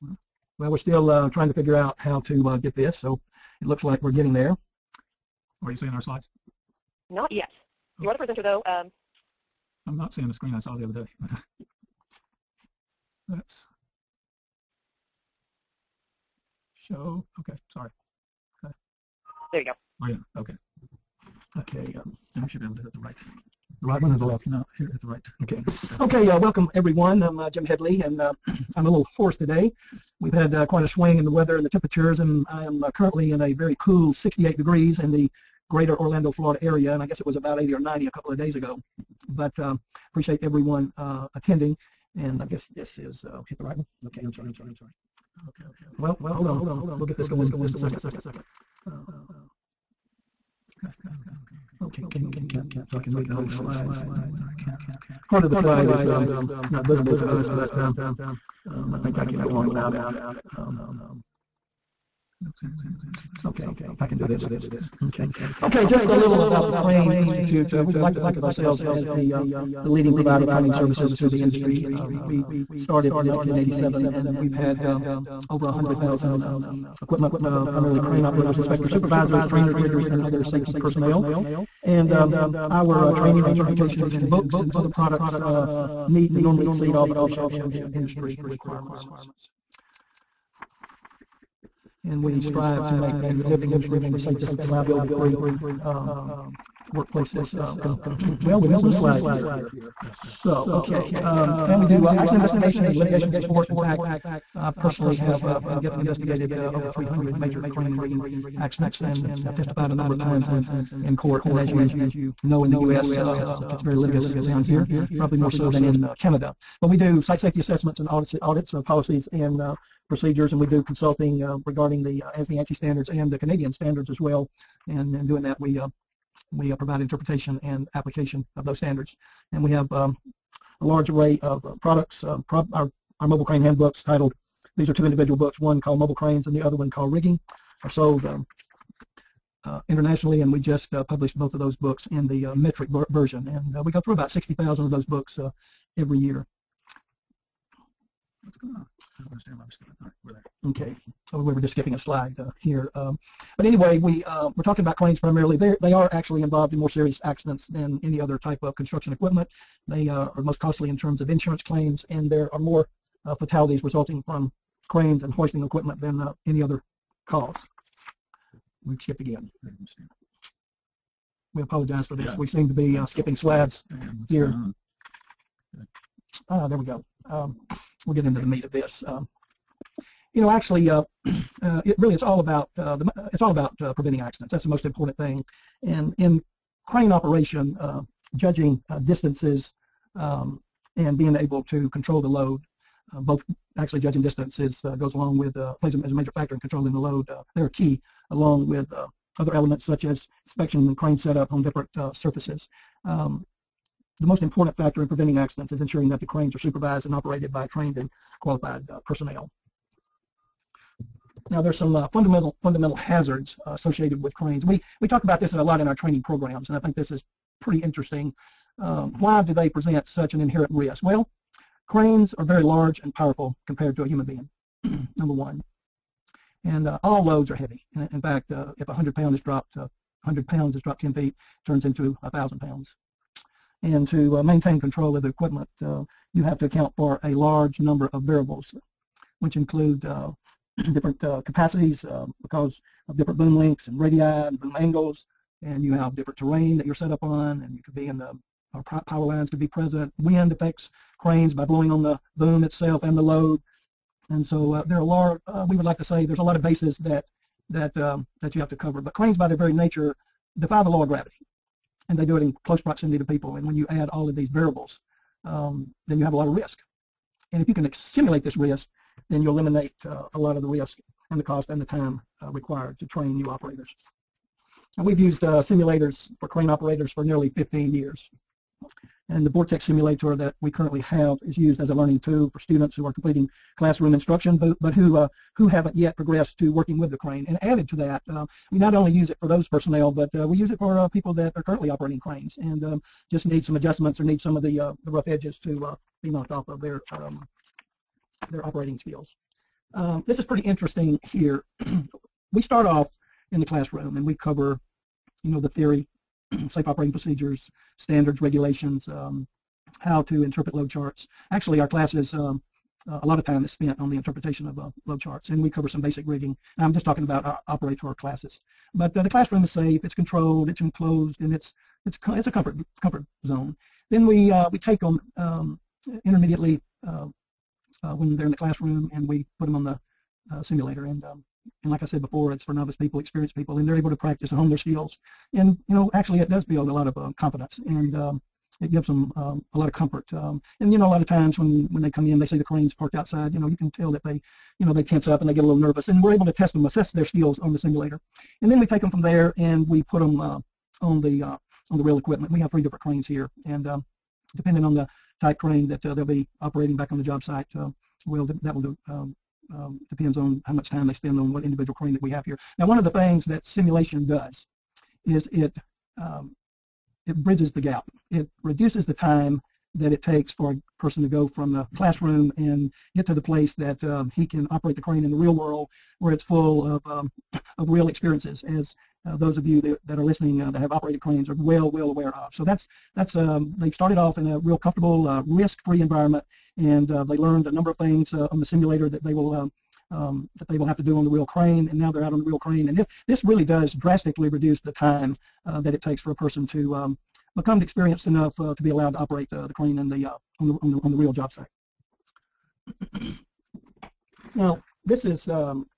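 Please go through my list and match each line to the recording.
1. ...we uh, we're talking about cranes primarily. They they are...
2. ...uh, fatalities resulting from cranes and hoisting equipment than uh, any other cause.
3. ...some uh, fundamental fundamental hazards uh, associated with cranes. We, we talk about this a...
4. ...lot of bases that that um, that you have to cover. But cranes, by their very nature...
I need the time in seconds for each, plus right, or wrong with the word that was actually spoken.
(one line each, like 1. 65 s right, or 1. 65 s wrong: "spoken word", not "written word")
1. 153 s right
2. 163 s right
3. 211 s right
4. 256 s right.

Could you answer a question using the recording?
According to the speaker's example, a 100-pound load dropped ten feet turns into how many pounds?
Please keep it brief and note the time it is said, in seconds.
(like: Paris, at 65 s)
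1,000 pounds, at 232 s.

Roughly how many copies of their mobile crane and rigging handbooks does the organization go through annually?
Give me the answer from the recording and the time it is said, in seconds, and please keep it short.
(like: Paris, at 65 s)
About 60,000, at 144 s.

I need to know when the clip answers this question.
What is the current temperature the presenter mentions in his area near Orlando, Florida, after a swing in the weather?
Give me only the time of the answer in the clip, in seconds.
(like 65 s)
34 s.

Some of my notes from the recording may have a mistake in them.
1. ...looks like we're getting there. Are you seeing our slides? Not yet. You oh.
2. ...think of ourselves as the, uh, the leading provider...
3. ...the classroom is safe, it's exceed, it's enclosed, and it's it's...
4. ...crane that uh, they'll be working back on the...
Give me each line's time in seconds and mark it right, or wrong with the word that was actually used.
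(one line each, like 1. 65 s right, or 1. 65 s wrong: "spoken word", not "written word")
1. 3 s right
2. 68 s right
3. 319 s wrong: "controlled", not "exceed"
4. 355 s wrong: "operating", not "working".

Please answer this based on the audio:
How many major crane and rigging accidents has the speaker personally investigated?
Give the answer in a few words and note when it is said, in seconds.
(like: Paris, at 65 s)
Over 300, at 106 s.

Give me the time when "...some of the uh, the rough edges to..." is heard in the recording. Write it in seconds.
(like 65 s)
294 s.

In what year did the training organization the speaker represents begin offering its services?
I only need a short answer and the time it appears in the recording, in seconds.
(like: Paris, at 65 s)
1987, at 73 s.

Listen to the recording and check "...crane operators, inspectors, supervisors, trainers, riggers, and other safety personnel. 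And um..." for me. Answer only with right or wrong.
right.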